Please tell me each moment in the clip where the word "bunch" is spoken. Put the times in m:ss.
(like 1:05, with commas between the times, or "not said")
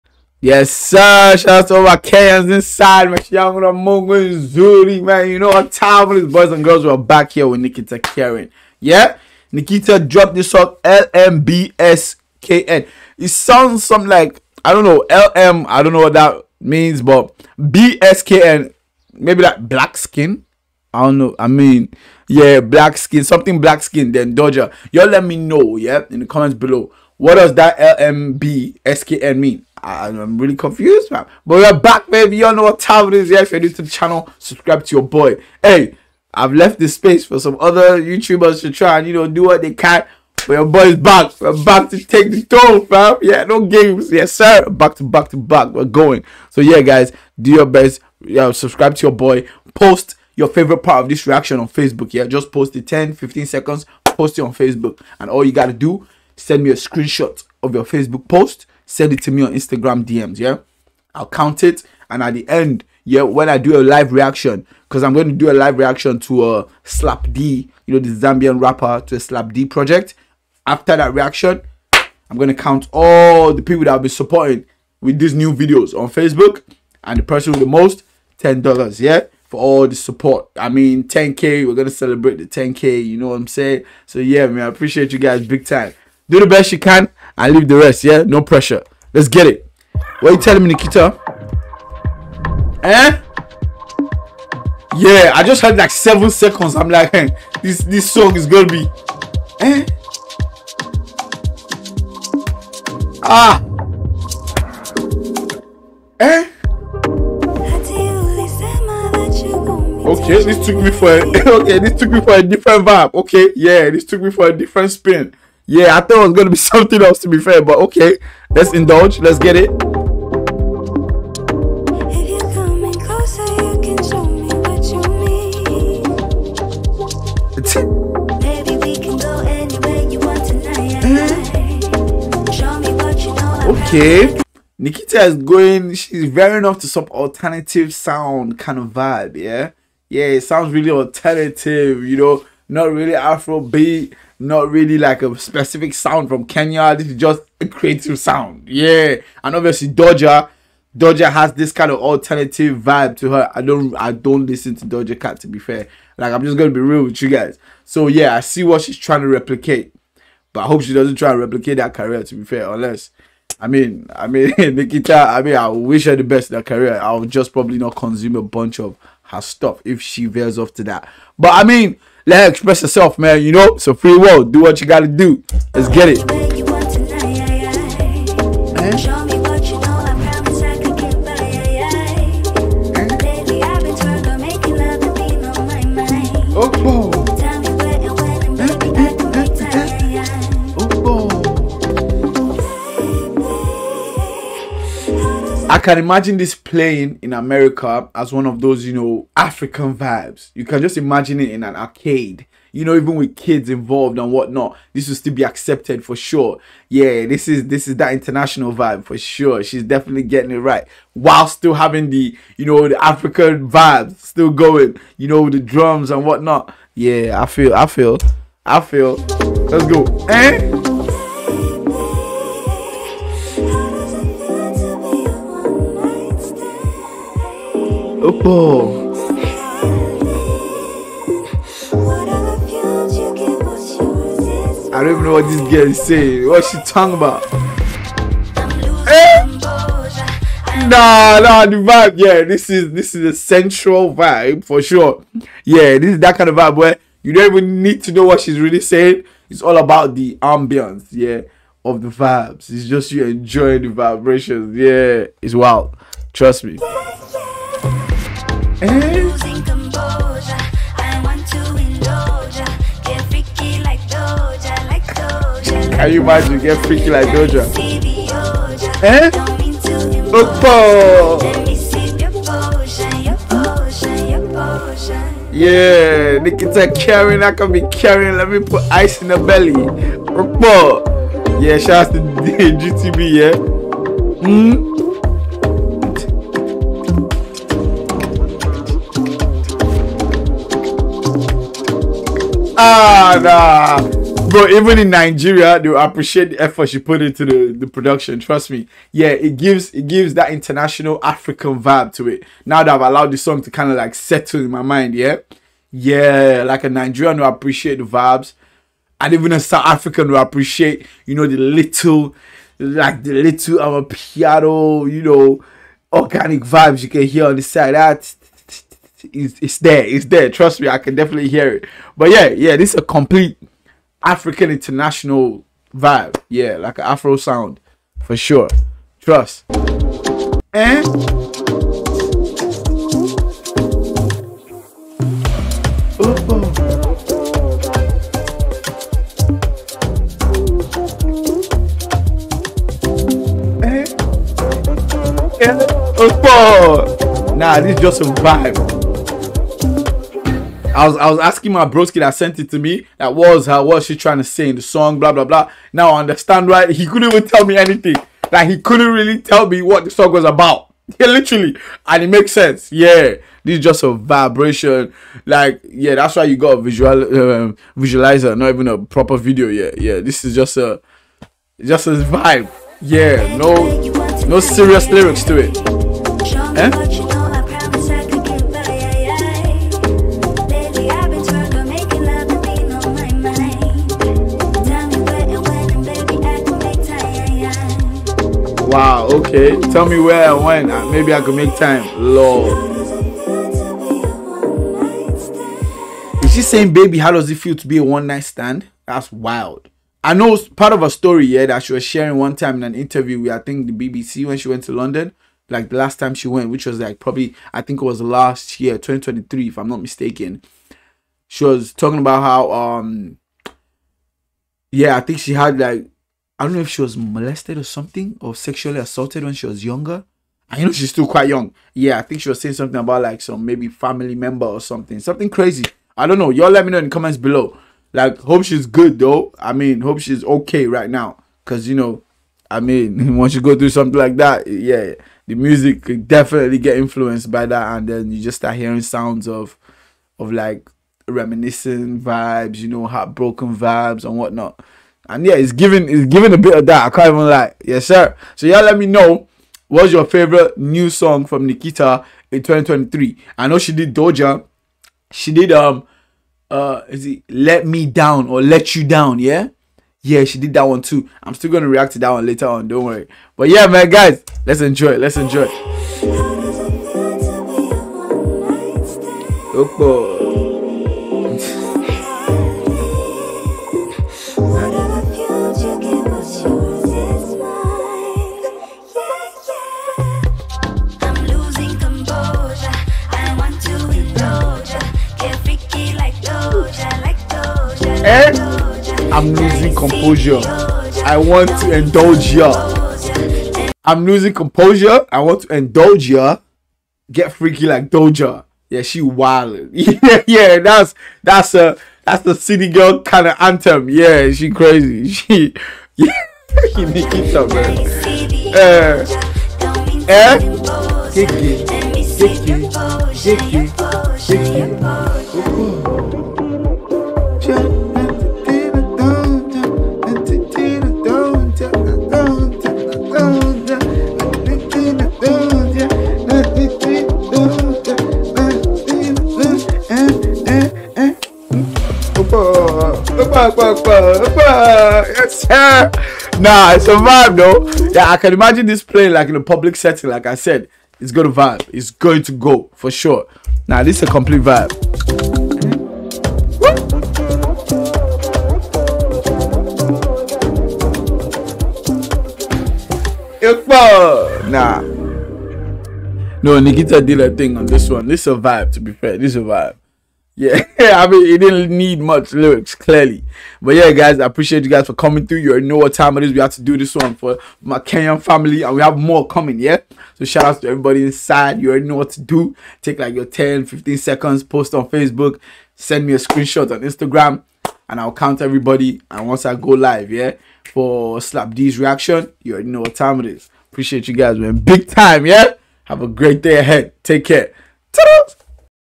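2:48.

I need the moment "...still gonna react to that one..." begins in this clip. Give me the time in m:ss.
7:41.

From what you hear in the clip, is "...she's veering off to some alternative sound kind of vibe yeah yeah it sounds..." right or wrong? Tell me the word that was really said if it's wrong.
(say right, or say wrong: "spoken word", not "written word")
right.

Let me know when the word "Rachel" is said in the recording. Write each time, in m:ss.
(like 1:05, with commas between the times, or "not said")
not said.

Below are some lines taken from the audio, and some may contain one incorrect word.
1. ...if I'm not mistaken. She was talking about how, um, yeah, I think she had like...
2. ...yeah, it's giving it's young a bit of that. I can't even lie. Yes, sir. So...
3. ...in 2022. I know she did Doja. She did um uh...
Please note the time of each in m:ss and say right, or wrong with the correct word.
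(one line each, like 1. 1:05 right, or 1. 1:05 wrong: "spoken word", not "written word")
1. 6:49 right
2. 7:25 wrong: "giving", not "young"
3. 7:32 wrong: "2023", not "2022".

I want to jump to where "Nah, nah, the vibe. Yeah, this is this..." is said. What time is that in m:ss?
4:00.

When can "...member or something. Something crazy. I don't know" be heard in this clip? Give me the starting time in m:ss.
7:04.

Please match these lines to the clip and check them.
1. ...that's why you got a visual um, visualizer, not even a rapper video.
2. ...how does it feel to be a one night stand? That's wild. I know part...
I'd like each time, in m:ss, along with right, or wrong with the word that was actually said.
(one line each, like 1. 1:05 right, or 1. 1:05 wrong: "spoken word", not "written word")
1. 6:06 wrong: "proper", not "rapper"
2. 6:37 right.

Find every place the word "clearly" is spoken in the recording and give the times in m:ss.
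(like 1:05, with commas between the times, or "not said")
9:22.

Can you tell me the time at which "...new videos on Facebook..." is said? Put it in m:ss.
1:15.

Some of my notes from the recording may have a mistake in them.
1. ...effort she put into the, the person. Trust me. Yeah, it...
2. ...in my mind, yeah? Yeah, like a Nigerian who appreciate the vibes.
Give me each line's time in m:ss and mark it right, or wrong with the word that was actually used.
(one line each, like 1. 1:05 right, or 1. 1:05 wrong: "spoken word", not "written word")
1. 4:56 wrong: "production", not "person"
2. 5:04 right.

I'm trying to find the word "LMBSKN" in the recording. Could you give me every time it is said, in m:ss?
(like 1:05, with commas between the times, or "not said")
0:10, 0:27.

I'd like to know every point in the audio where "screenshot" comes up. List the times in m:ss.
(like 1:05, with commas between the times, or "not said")
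0:56, 9:36.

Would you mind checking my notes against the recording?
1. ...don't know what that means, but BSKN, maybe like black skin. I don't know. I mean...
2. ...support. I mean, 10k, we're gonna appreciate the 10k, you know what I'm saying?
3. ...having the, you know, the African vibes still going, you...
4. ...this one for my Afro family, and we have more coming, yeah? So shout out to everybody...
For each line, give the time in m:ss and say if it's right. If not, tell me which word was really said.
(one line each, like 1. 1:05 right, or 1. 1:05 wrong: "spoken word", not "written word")
1. 0:15 right
2. 1:19 wrong: "celebrate", not "appreciate"
3. 3:31 right
4. 9:26 wrong: "Kenyan", not "Afro".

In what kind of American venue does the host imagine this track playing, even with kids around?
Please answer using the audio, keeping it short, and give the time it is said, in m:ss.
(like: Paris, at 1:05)
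An arcade, at 3:21.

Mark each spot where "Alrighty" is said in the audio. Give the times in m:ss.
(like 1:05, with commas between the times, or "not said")
not said.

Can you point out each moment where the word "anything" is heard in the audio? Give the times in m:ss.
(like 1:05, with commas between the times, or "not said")
5:57.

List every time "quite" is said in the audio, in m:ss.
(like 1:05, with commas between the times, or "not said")
7:01.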